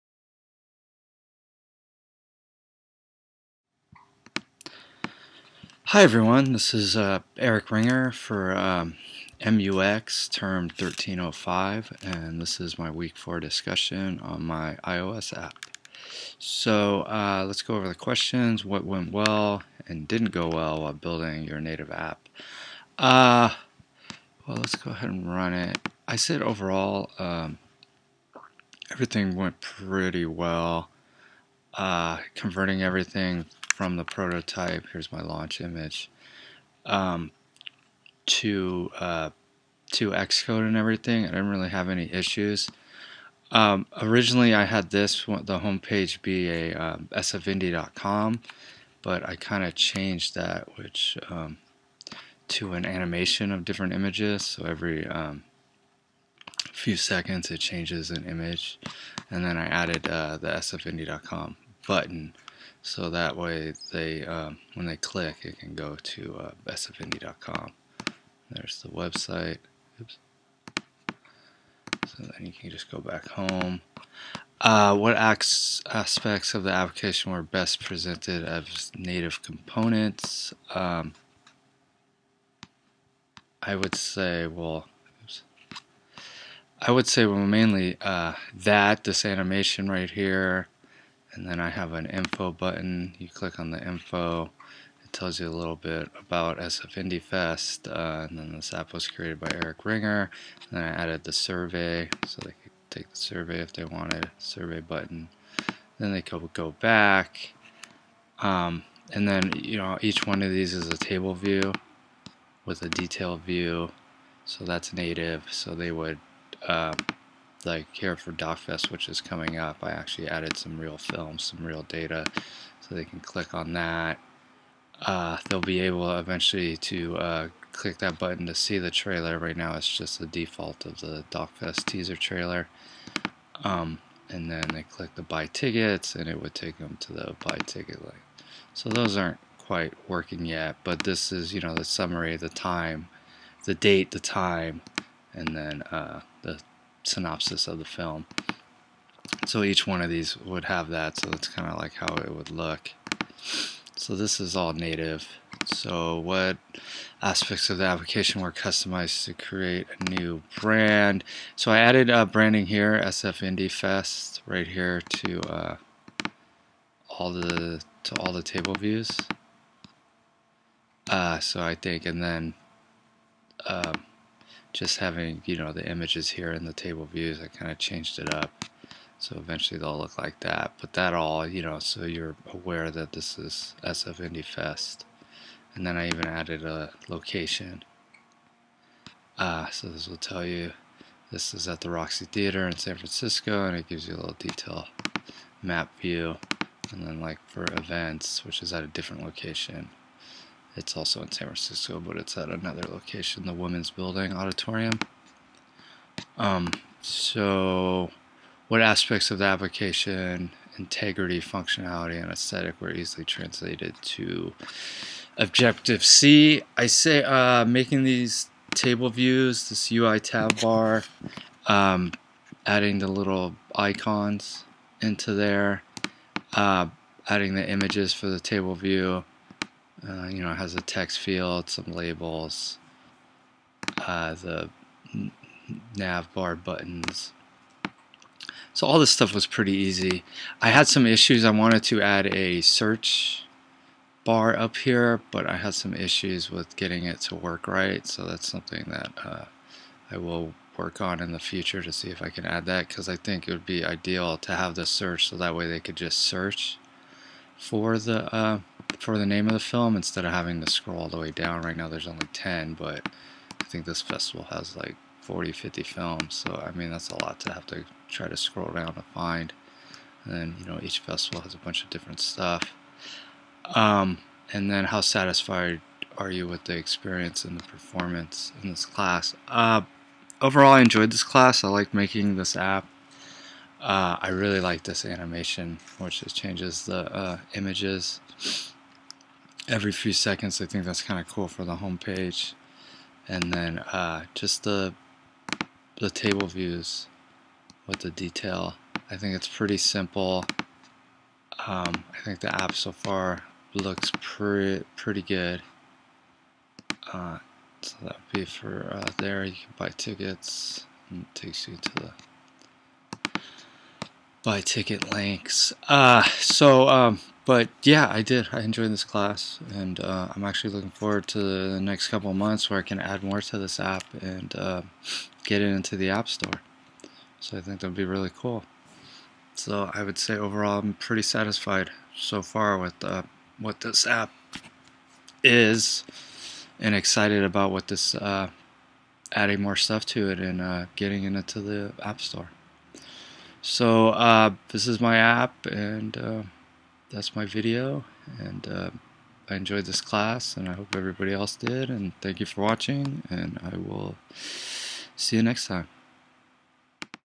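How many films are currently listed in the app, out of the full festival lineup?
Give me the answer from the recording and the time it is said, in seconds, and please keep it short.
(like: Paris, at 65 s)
10, at 262 s.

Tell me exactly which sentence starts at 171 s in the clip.
Uh, so I think, and then.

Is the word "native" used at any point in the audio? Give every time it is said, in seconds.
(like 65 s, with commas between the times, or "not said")
21 s, 78 s, 114 s, 154 s.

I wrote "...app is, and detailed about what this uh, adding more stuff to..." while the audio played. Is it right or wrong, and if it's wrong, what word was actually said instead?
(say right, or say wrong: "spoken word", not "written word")
wrong: "excited", not "detailed".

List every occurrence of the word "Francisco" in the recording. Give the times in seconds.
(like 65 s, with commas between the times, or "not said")
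192 s, 201 s.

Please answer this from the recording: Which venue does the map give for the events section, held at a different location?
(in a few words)
Women's Building Auditorium.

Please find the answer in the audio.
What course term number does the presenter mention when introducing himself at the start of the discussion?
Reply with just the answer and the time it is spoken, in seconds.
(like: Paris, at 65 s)
1305, at 10 s.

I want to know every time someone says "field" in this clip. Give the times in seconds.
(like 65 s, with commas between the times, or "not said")
231 s.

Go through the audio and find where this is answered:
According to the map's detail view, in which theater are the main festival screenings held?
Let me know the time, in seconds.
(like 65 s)
191 s.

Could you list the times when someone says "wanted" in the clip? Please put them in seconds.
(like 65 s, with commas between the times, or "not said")
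103 s, 241 s.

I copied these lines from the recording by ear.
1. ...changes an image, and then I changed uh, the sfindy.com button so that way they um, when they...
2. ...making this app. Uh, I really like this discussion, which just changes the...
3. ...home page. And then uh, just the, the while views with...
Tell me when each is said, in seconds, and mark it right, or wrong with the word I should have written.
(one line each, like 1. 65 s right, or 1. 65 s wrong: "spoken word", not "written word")
1. 57 s wrong: "added", not "changed"
2. 281 s wrong: "animation", not "discussion"
3. 291 s wrong: "table", not "while".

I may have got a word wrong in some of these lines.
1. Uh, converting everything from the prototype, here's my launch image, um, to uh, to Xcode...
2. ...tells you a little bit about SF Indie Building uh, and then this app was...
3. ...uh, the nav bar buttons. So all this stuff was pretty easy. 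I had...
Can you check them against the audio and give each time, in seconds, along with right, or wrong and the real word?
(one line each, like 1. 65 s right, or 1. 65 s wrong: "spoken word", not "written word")
1. 31 s right
2. 95 s wrong: "Fest", not "Building"
3. 233 s right.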